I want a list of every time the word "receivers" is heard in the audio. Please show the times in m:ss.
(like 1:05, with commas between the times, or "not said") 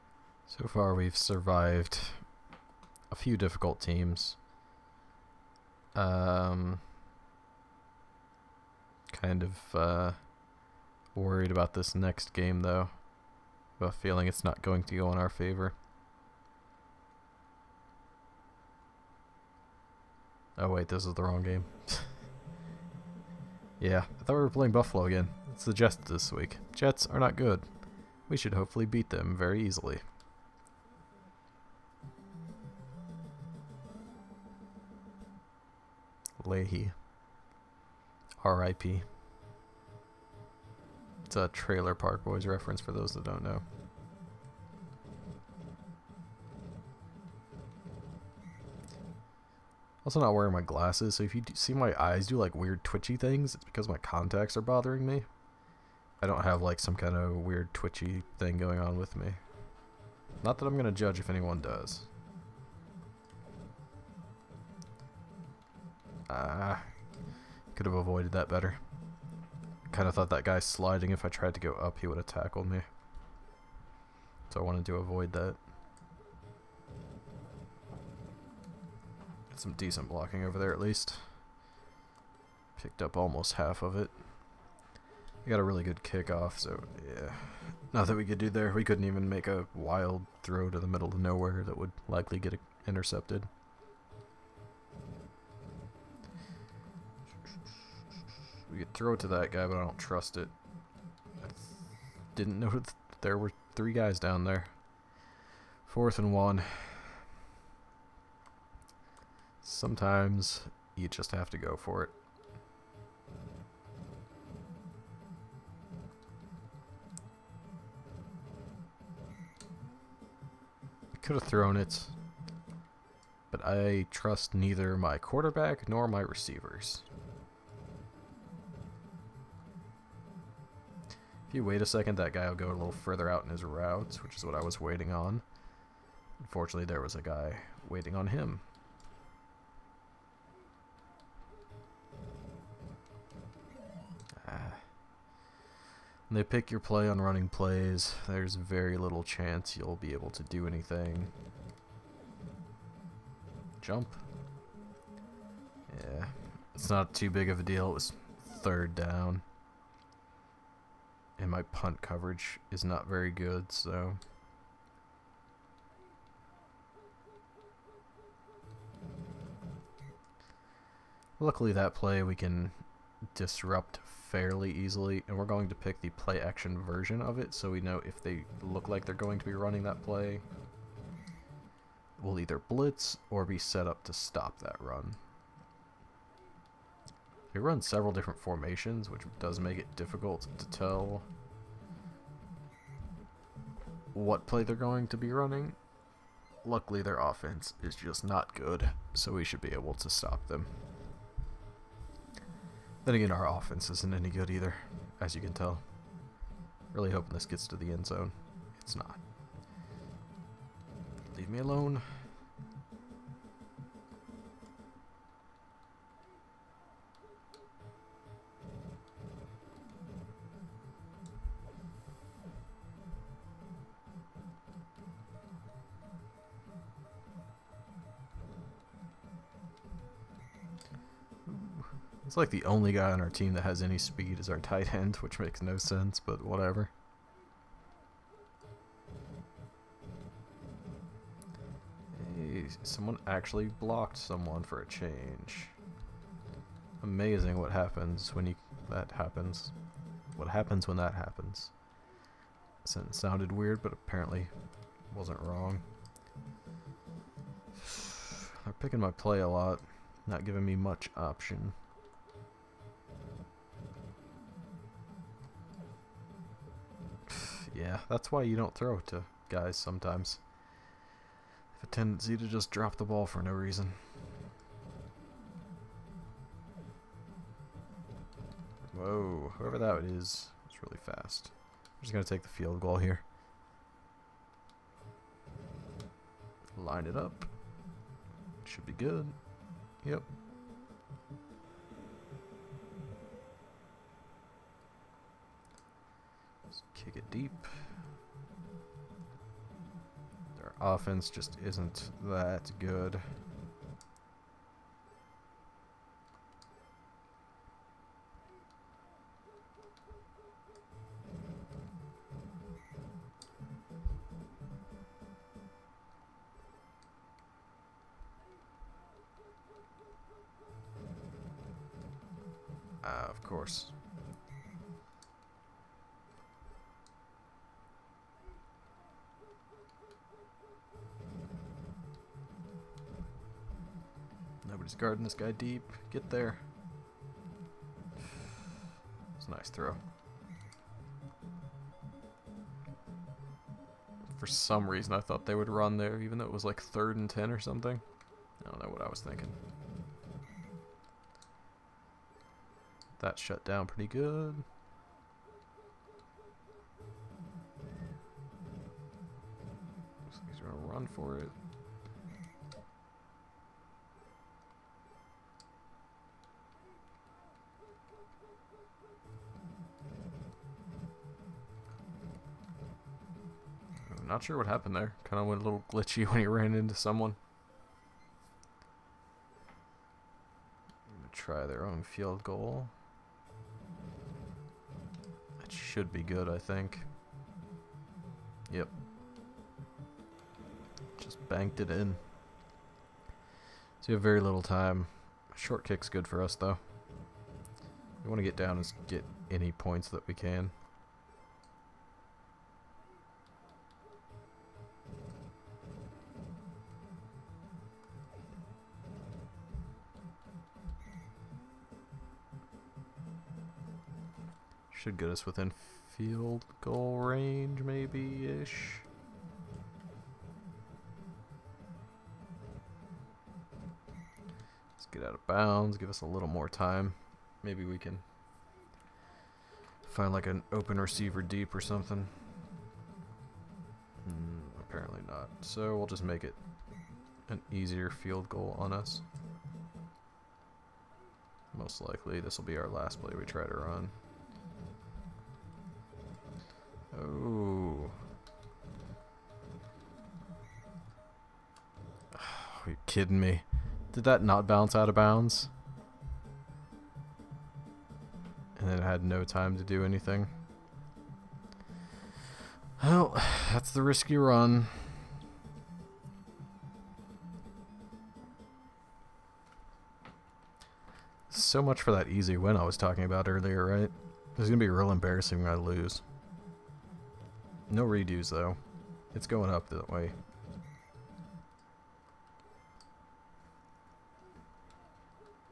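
2:06, 7:11.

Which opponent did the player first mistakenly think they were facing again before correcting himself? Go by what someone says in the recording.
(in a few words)
Buffalo.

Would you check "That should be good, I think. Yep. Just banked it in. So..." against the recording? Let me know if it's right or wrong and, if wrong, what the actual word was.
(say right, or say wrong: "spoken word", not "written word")
right.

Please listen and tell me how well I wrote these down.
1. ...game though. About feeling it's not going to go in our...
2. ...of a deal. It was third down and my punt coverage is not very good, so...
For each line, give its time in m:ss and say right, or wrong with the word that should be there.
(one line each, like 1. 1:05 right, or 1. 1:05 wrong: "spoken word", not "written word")
1. 0:12 right
2. 2:37 right.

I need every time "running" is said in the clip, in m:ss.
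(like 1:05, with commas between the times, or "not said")
2:27, 2:59, 3:15.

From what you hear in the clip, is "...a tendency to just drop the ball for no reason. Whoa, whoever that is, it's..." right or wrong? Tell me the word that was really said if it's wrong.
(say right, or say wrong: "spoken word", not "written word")
right.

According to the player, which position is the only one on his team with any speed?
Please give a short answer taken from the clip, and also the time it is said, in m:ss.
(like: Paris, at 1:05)
tight end, at 3:54.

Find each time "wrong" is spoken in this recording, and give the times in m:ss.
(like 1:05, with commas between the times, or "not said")
0:21, 4:15.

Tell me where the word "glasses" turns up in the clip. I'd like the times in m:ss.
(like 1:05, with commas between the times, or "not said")
0:50.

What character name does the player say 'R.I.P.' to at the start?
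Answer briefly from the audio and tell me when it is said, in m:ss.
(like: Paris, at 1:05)
Lahey, at 0:36.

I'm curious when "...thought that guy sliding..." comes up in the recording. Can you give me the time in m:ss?
1:10.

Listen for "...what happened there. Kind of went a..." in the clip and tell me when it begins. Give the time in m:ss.
6:14.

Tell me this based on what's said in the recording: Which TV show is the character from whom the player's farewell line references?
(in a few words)
Trailer Park Boys.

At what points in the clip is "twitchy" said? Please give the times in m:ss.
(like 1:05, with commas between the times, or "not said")
0:52, 0:57.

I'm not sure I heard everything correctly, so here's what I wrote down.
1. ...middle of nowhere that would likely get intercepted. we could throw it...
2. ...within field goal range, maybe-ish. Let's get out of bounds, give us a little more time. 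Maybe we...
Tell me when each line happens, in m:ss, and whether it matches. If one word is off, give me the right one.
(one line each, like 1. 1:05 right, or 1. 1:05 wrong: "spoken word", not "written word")
1. 1:30 right
2. 6:55 right.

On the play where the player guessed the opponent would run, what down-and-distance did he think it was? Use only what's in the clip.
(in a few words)
third and 10.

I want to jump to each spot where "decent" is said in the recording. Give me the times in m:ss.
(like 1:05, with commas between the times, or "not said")
1:19.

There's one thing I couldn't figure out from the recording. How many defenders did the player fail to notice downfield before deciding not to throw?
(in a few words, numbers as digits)
3.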